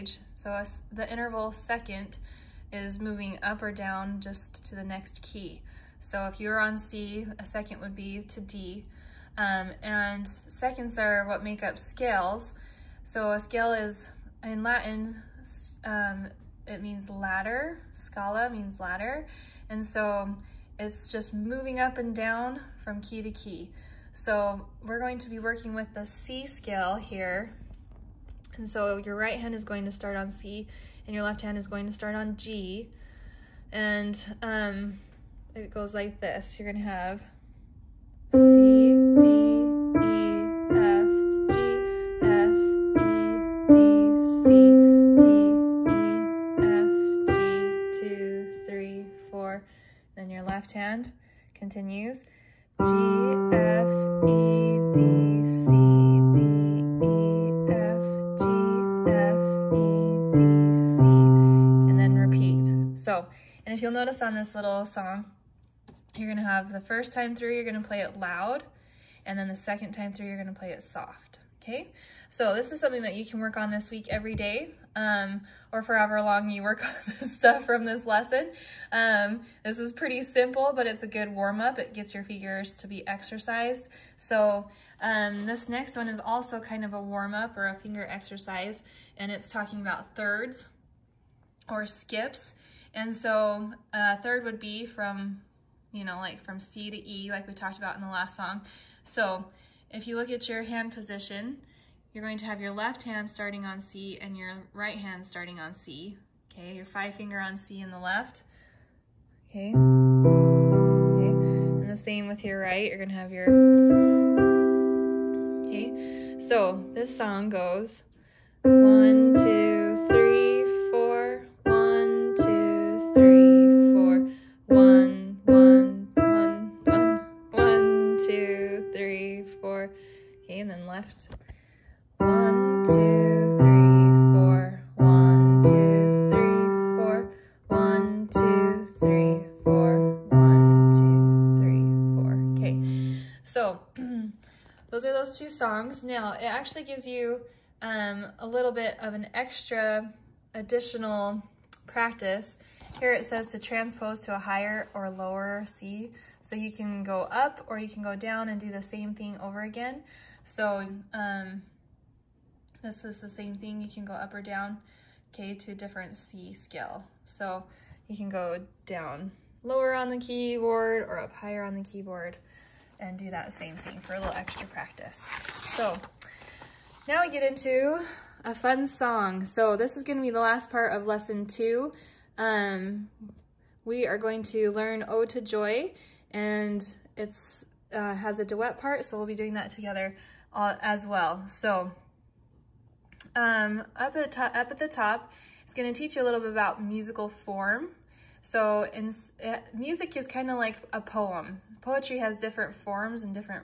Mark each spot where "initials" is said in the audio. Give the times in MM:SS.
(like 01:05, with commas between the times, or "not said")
not said.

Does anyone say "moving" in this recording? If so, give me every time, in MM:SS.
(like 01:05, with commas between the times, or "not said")
00:02, 00:21.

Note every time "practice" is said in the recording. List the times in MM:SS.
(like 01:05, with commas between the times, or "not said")
02:31, 02:54.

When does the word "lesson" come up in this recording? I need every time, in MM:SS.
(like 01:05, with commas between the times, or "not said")
01:18, 03:01.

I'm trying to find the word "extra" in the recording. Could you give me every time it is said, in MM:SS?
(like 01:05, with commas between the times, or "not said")
02:29, 02:54.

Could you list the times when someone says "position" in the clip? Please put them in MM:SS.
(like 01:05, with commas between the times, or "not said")
01:40.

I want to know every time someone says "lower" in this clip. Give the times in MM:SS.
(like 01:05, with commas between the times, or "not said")
02:35, 02:49.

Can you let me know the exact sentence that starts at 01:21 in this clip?
It gets your fingers to be exercised.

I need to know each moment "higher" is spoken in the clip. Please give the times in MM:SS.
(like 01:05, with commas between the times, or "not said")
02:34, 02:51.